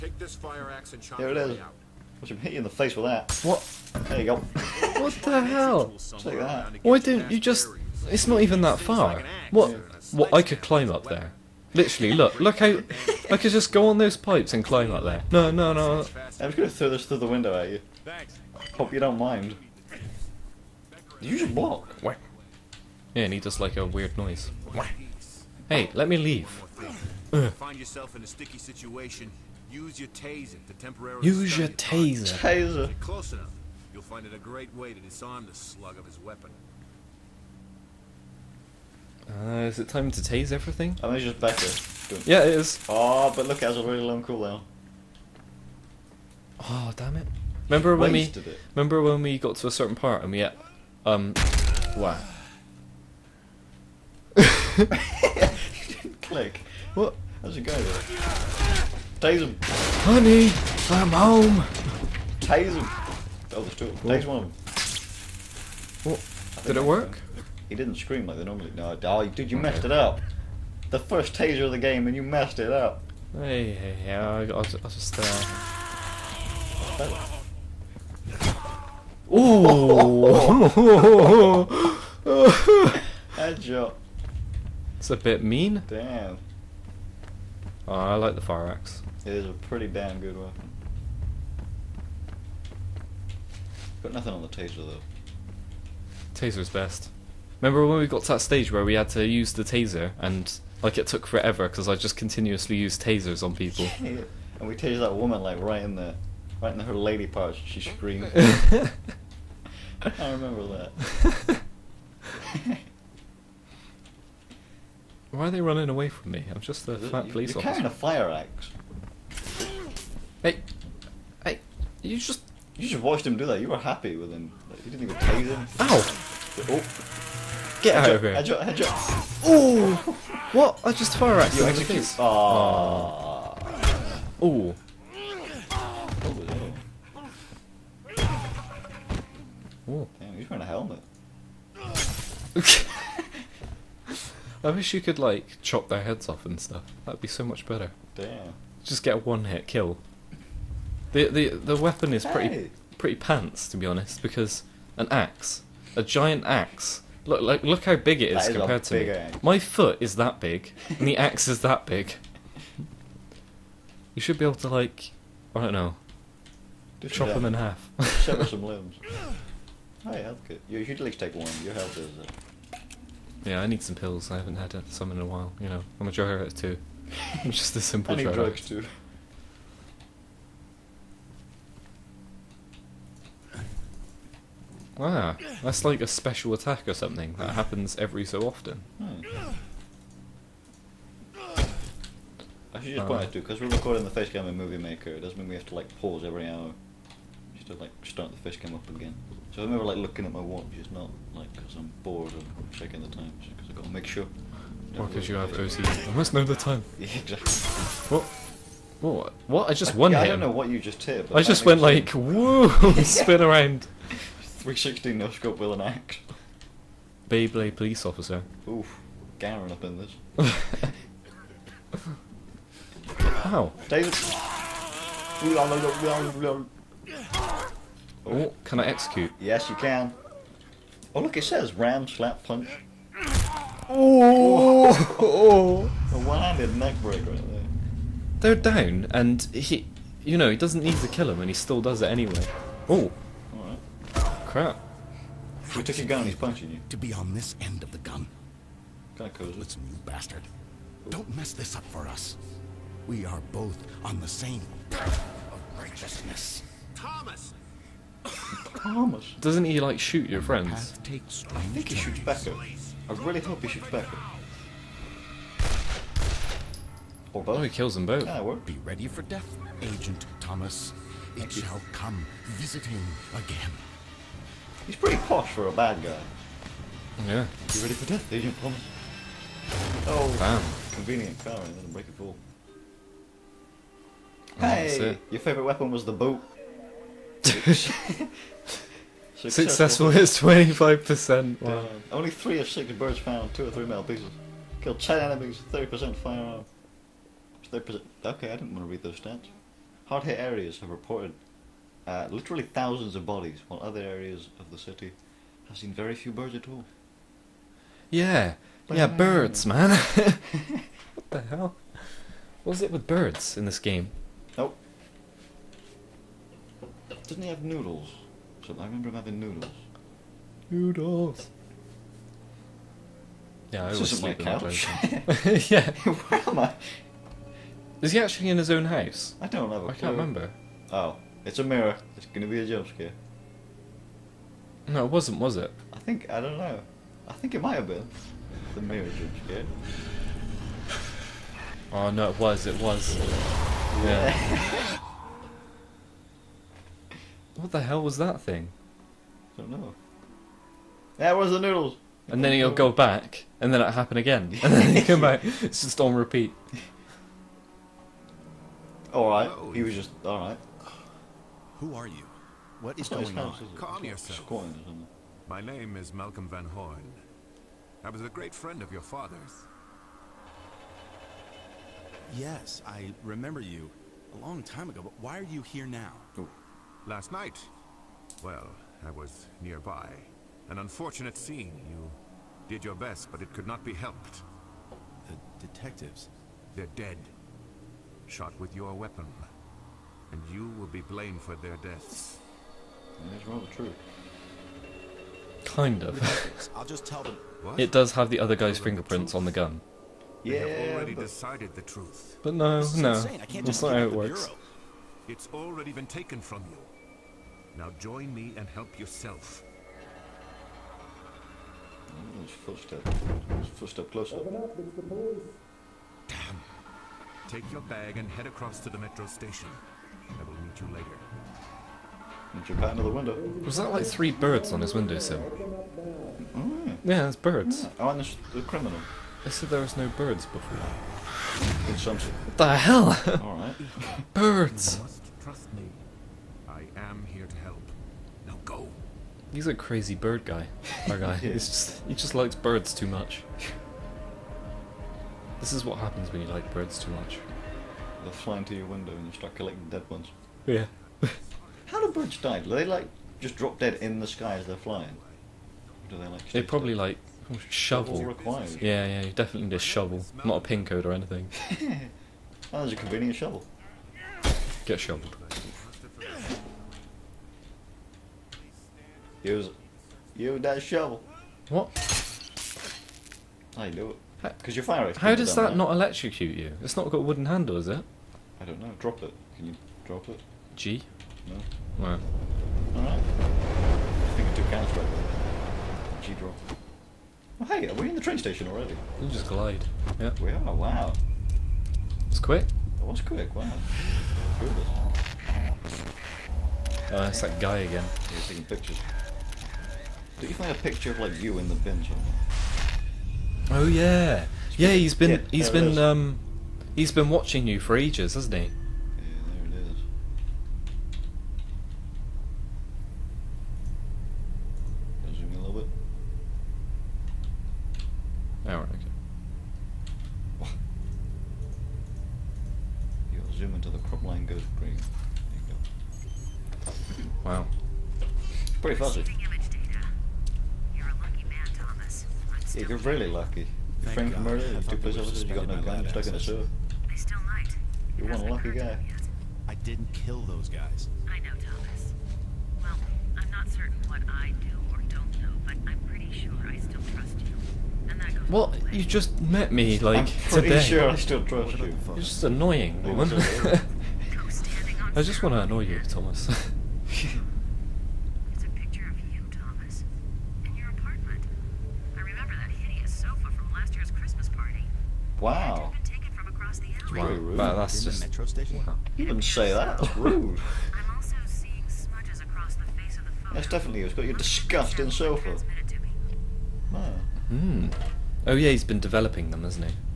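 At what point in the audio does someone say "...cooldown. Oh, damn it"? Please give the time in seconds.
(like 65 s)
44 s.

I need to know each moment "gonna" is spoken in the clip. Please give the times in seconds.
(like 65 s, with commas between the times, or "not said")
16 s, 332 s.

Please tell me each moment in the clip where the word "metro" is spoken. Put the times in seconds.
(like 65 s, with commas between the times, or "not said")
418 s, 568 s.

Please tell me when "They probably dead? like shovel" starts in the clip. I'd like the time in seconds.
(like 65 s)
456 s.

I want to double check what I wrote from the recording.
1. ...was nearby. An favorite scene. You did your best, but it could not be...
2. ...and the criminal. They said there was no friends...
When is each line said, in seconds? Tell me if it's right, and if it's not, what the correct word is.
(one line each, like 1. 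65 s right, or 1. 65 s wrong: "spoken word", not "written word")
1. 379 s wrong: "unfortunate", not "favorite"
2. 428 s wrong: "birds", not "friends".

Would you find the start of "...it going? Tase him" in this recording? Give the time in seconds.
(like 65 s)
57 s.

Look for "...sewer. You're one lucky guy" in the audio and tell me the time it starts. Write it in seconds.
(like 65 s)
536 s.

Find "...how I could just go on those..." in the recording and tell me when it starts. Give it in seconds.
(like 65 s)
12 s.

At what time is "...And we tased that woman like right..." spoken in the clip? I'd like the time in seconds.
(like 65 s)
104 s.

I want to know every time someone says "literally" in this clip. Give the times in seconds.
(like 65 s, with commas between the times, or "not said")
11 s, 302 s.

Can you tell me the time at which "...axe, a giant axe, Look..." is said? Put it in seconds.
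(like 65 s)
155 s.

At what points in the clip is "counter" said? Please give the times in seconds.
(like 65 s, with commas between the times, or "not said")
484 s.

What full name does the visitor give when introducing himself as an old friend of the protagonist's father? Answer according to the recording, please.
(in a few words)
Malcolm Van Horn.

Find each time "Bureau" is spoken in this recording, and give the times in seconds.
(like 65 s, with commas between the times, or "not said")
404 s.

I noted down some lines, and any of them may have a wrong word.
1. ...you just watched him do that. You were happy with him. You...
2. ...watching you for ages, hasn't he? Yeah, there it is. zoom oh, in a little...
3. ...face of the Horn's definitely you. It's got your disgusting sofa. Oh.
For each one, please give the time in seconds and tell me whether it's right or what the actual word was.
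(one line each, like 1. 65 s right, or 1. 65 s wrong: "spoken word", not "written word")
1. 122 s right
2. 507 s right
3. 572 s wrong: "That", not "Horn".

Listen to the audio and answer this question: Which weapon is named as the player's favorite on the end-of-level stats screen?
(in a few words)
The boot.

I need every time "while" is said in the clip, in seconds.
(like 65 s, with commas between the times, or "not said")
175 s, 303 s.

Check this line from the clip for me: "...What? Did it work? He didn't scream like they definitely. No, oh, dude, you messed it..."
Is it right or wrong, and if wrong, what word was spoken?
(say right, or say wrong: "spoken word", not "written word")
wrong: "normally", not "definitely".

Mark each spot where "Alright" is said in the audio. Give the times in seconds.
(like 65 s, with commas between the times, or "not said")
433 s, 482 s.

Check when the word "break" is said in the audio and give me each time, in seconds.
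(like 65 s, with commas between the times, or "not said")
237 s, 281 s.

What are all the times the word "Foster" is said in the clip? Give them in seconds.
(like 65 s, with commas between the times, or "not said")
not said.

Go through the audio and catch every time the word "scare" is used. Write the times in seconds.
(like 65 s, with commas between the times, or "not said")
332 s, 339 s.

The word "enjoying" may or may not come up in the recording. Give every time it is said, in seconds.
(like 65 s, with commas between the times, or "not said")
not said.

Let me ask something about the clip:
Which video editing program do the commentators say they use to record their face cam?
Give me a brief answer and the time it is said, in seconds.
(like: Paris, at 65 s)
Movie Maker, at 194 s.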